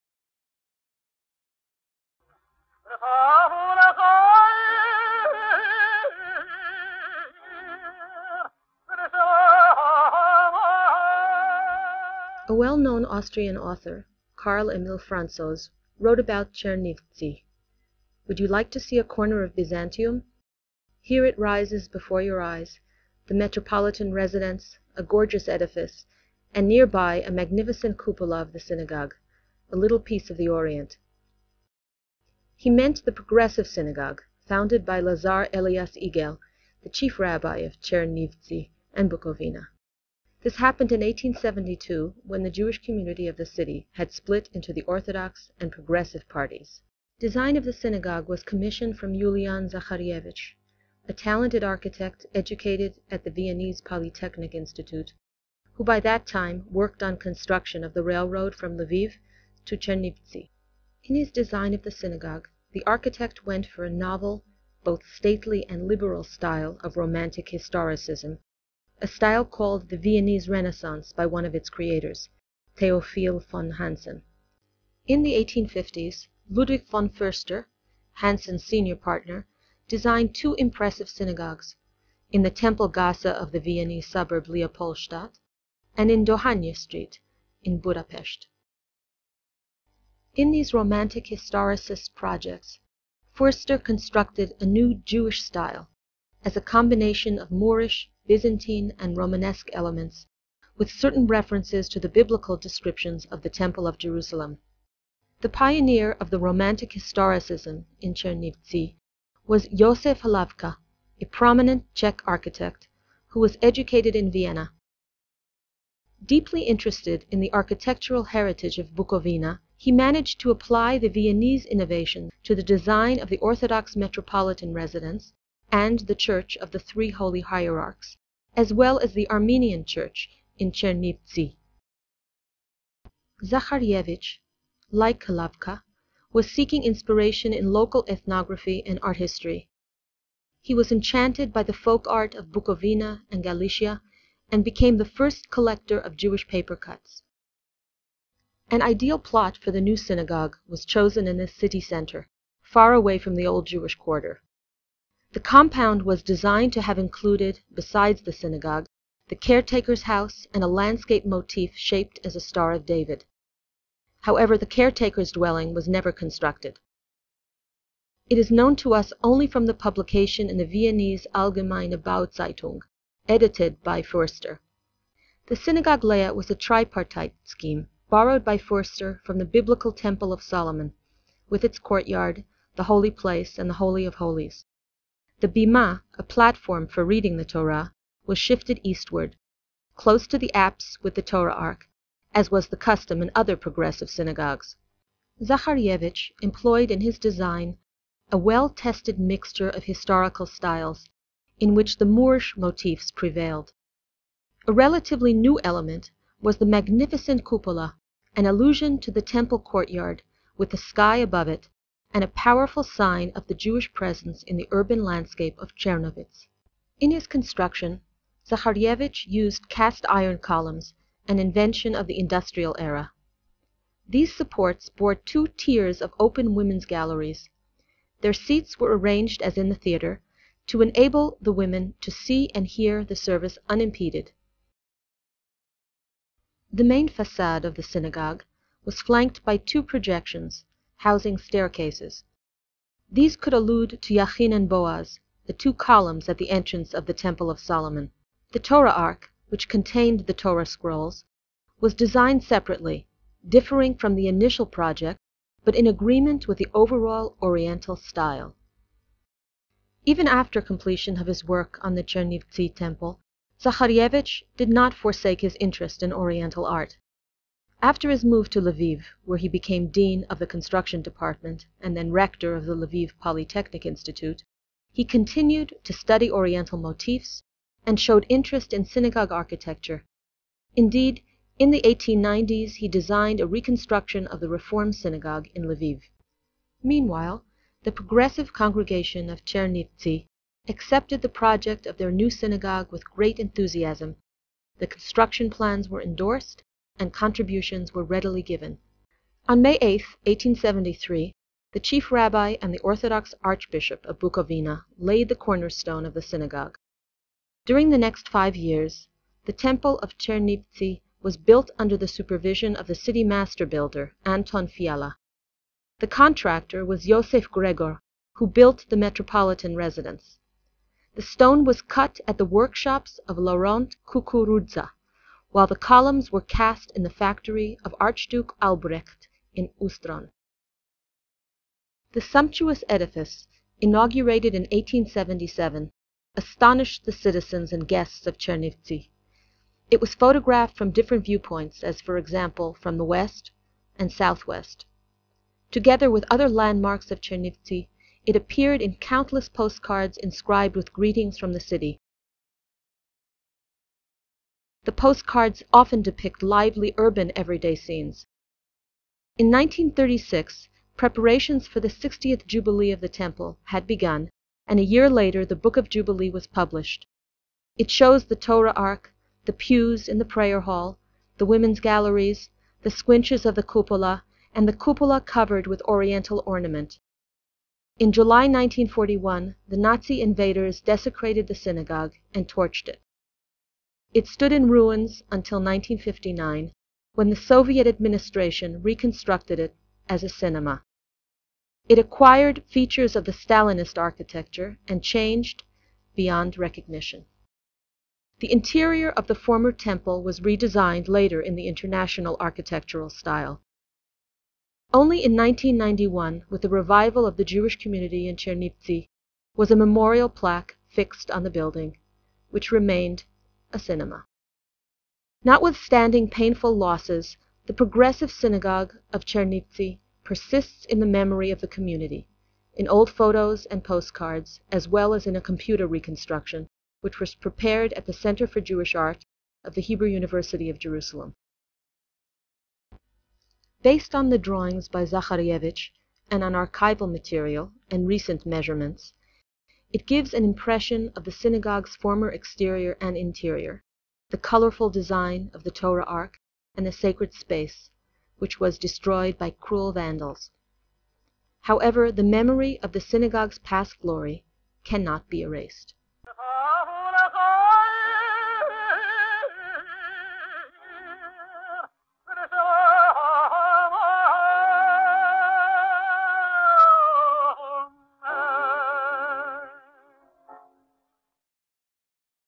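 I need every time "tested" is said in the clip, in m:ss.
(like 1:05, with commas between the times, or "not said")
3:18.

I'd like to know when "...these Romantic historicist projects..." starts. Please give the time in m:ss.
1:30.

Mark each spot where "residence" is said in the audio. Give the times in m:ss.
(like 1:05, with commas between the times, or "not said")
0:24, 2:04, 5:19.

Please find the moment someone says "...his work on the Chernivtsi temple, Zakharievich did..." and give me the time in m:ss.
4:21.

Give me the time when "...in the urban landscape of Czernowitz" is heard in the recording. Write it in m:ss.
3:34.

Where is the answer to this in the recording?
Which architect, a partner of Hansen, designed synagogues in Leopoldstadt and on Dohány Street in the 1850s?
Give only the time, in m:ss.
1:16.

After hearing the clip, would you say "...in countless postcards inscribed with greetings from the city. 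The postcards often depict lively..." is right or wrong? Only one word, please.
right.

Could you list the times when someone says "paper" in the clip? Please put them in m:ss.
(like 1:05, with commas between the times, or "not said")
2:26.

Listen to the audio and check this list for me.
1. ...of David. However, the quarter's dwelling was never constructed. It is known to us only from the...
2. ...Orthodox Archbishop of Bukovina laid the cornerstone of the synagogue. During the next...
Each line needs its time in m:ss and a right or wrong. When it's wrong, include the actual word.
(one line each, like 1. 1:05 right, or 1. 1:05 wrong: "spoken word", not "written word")
1. 2:42 wrong: "caretaker", not "quarter"
2. 5:02 right.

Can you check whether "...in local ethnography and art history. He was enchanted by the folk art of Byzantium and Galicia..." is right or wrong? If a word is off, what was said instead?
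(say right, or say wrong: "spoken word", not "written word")
wrong: "Bukovina", not "Byzantium".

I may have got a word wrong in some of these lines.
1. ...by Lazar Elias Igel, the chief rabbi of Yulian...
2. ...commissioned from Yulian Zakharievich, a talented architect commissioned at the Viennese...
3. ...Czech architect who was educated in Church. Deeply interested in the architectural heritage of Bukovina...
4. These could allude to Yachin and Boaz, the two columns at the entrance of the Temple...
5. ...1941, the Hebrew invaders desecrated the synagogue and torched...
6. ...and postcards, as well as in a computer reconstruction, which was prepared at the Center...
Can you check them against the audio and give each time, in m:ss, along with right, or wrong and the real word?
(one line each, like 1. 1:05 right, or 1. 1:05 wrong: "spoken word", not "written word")
1. 0:34 wrong: "Chernivtsi", not "Yulian"
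2. 0:48 wrong: "educated", not "commissioned"
3. 1:51 wrong: "Vienna", not "Church"
4. 4:03 right
5. 6:18 wrong: "Nazi", not "Hebrew"
6. 7:03 right.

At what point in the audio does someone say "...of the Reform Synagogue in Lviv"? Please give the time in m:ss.
4:44.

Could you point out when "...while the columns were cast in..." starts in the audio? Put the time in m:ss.
5:25.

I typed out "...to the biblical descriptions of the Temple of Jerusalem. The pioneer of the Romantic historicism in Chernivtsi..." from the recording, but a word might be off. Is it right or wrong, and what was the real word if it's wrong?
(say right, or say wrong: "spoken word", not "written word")
right.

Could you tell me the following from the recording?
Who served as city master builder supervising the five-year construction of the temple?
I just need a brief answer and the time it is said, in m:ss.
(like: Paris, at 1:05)
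Anton Fiala, at 5:14.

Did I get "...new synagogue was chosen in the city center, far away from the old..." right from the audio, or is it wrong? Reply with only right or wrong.
right.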